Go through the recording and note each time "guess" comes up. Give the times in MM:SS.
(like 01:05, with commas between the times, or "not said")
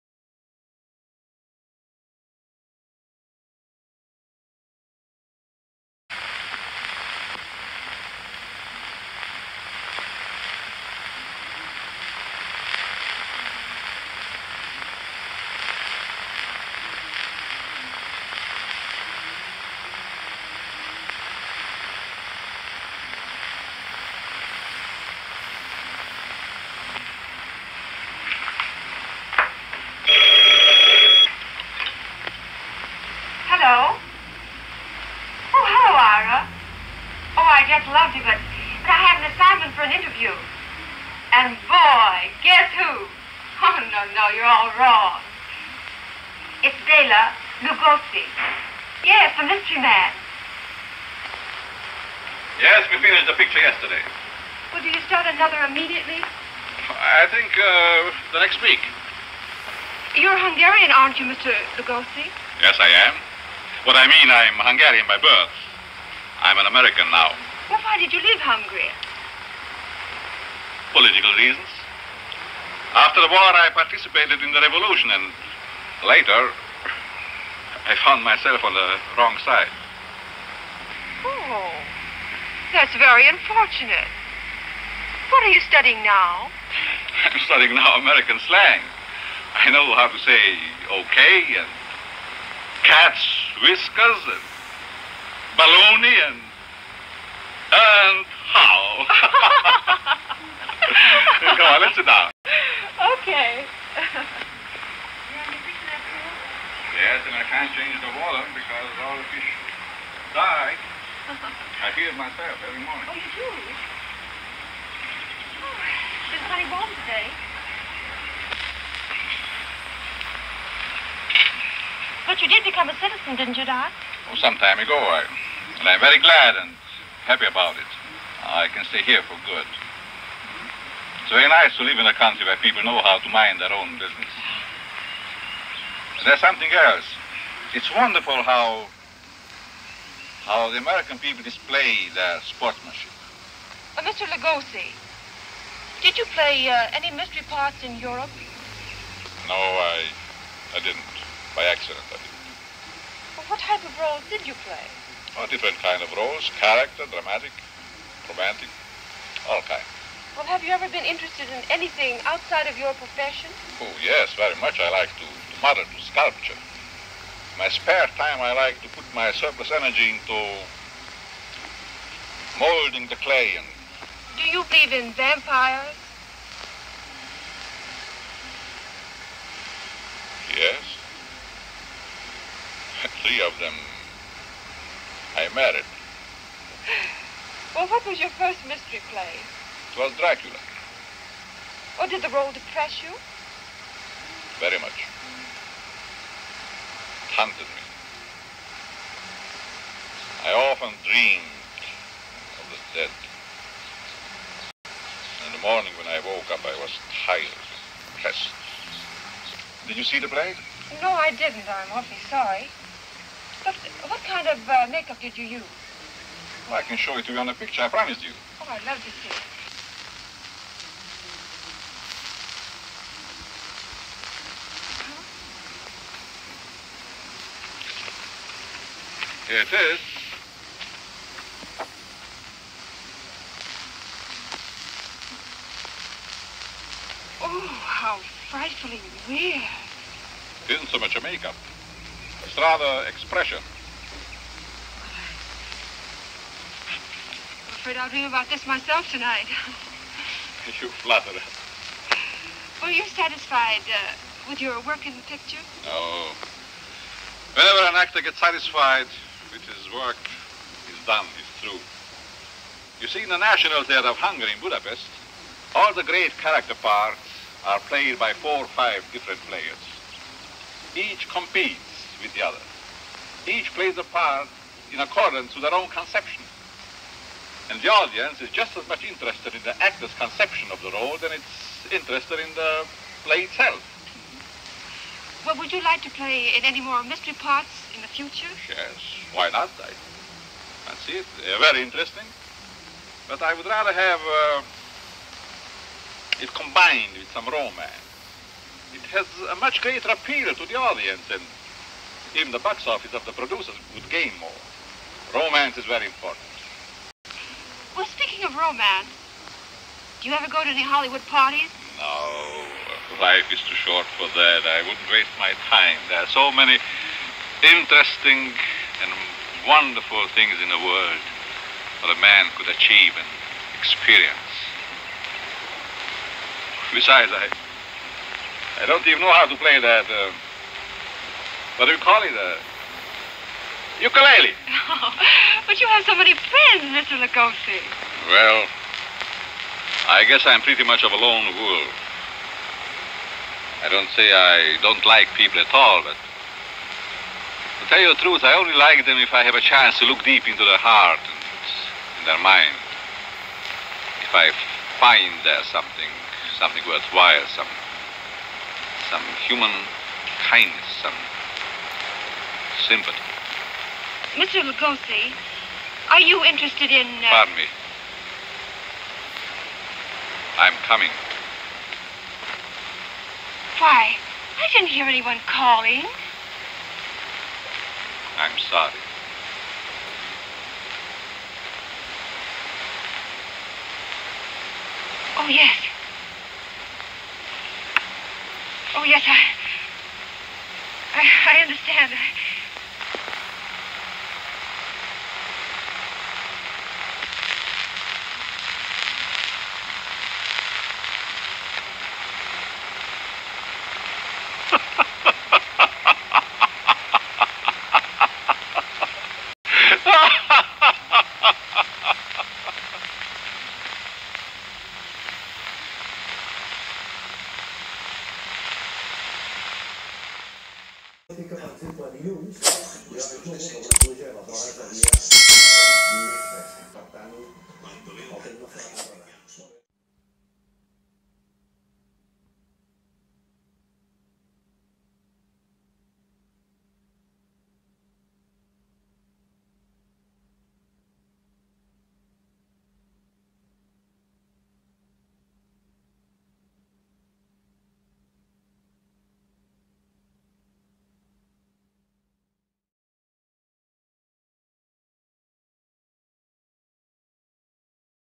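00:42, 05:40.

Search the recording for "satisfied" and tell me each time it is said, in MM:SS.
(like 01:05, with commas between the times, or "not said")
04:13, 04:18.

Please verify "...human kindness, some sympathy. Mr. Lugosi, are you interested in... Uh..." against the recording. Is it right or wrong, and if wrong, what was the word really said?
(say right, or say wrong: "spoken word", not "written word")
right.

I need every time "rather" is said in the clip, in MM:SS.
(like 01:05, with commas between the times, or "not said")
04:02, 04:53.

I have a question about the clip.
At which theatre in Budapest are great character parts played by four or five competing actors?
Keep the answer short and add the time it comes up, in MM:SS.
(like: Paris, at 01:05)
National Theatre of Hungary, at 04:23.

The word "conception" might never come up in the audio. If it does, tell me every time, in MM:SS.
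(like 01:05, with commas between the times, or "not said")
04:35, 04:40.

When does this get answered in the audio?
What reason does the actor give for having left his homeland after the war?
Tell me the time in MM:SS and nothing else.
01:10.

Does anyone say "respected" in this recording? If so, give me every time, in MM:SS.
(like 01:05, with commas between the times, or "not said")
not said.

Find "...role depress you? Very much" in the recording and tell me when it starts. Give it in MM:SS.
03:12.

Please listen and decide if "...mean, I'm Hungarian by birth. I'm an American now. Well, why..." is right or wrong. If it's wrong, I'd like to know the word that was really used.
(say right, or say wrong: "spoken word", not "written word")
right.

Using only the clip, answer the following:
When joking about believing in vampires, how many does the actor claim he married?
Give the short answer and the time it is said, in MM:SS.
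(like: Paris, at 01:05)
3, at 03:03.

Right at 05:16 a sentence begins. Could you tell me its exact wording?
There are so many interesting and wonderful things in the world that a man could achieve and experience.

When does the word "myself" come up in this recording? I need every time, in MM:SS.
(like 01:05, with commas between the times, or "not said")
01:18, 01:52, 04:08.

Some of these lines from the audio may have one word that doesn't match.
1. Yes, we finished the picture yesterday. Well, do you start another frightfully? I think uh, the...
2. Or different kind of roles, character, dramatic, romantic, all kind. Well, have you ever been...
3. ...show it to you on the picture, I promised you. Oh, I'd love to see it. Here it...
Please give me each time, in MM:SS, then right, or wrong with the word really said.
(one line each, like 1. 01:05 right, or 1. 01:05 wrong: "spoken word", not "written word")
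1. 00:52 wrong: "immediately", not "frightfully"
2. 02:35 right
3. 03:36 right.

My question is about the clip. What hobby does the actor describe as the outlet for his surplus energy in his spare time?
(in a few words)
Sculpture.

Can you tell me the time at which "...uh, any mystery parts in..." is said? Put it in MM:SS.
02:26.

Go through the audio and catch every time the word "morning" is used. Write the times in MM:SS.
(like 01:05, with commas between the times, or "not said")
01:52, 03:25.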